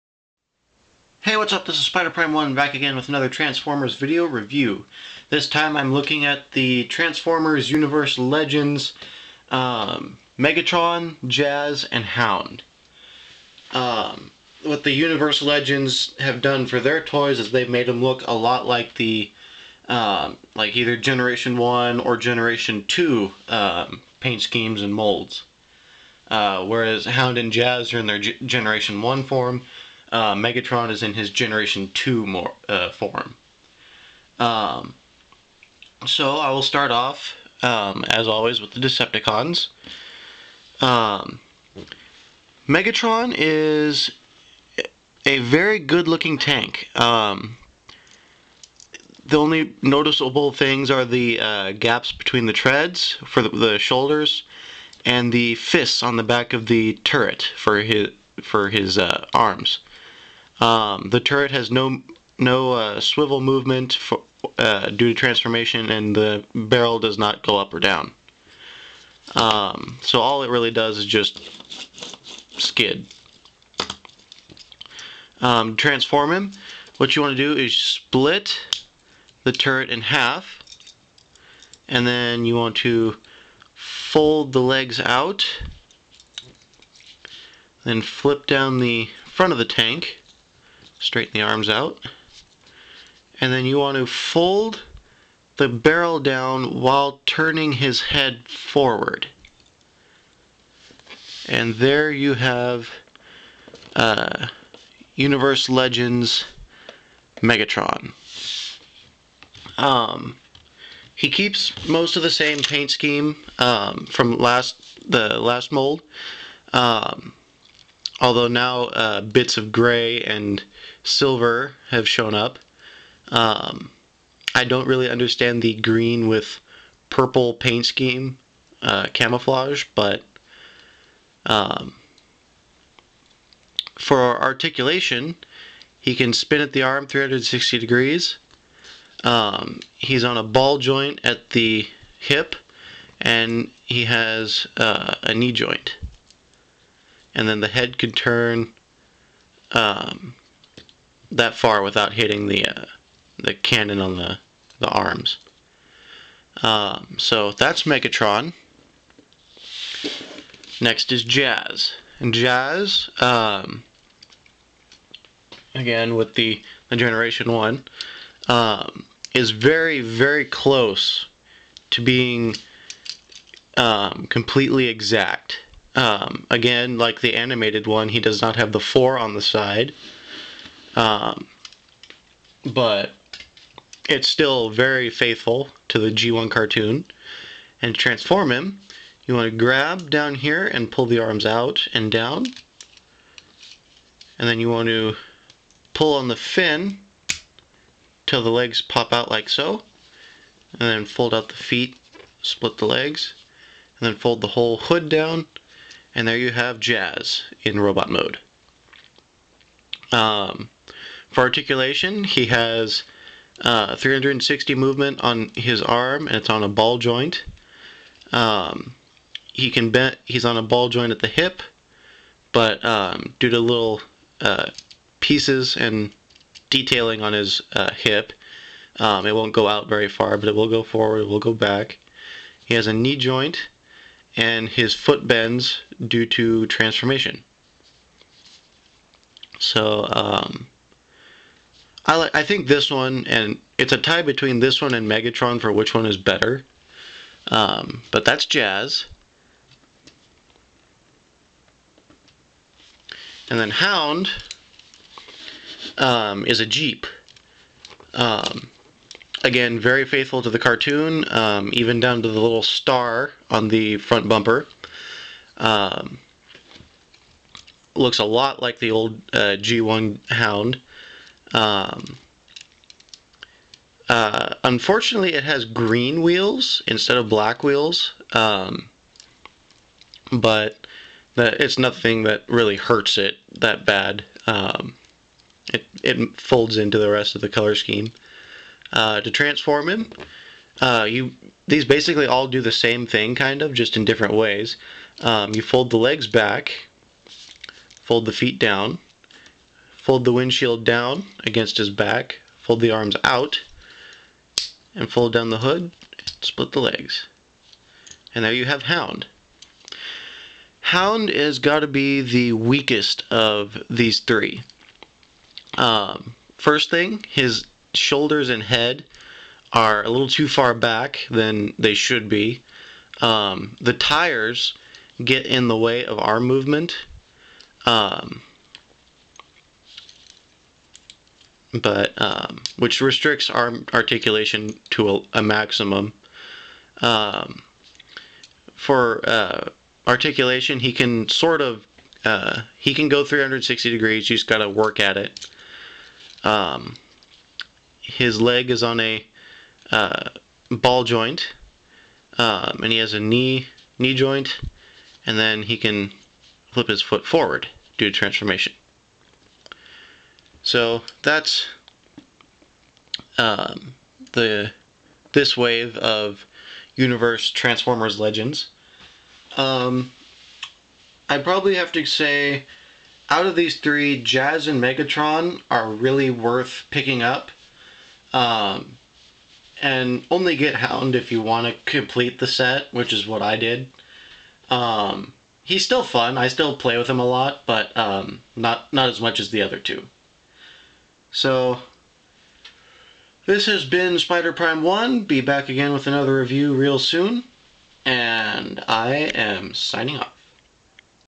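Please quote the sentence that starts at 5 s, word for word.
This time I'm looking at the Transformers Universe Legends um, Megatron, Jazz, and Hound.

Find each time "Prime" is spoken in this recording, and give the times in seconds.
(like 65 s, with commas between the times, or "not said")
2 s, 394 s.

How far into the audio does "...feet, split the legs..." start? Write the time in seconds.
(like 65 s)
201 s.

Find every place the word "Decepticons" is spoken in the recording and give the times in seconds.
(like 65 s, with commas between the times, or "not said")
38 s.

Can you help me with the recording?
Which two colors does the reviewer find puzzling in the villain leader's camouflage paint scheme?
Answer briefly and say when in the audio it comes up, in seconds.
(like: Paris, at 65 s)
green with purple, at 125 s.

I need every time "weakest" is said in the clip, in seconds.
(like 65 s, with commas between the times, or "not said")
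312 s.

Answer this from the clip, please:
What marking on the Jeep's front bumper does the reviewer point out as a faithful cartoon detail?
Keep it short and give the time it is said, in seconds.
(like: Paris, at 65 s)
star, at 262 s.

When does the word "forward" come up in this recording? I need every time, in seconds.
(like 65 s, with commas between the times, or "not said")
98 s, 230 s, 357 s.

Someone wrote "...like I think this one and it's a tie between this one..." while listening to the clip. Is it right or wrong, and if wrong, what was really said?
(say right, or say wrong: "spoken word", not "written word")
right.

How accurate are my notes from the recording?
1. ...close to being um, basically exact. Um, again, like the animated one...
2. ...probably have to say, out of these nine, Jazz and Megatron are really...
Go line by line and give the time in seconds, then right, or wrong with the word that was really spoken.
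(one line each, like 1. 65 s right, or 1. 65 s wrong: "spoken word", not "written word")
1. 170 s wrong: "completely", not "basically"
2. 371 s wrong: "three", not "nine".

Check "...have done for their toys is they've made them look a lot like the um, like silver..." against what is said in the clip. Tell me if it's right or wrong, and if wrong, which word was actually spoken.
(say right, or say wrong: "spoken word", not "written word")
wrong: "either", not "silver".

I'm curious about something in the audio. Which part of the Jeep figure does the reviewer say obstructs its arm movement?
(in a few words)
the tires.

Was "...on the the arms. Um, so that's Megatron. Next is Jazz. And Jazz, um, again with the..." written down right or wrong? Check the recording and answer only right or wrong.
right.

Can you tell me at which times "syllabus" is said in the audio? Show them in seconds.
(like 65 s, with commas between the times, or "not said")
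not said.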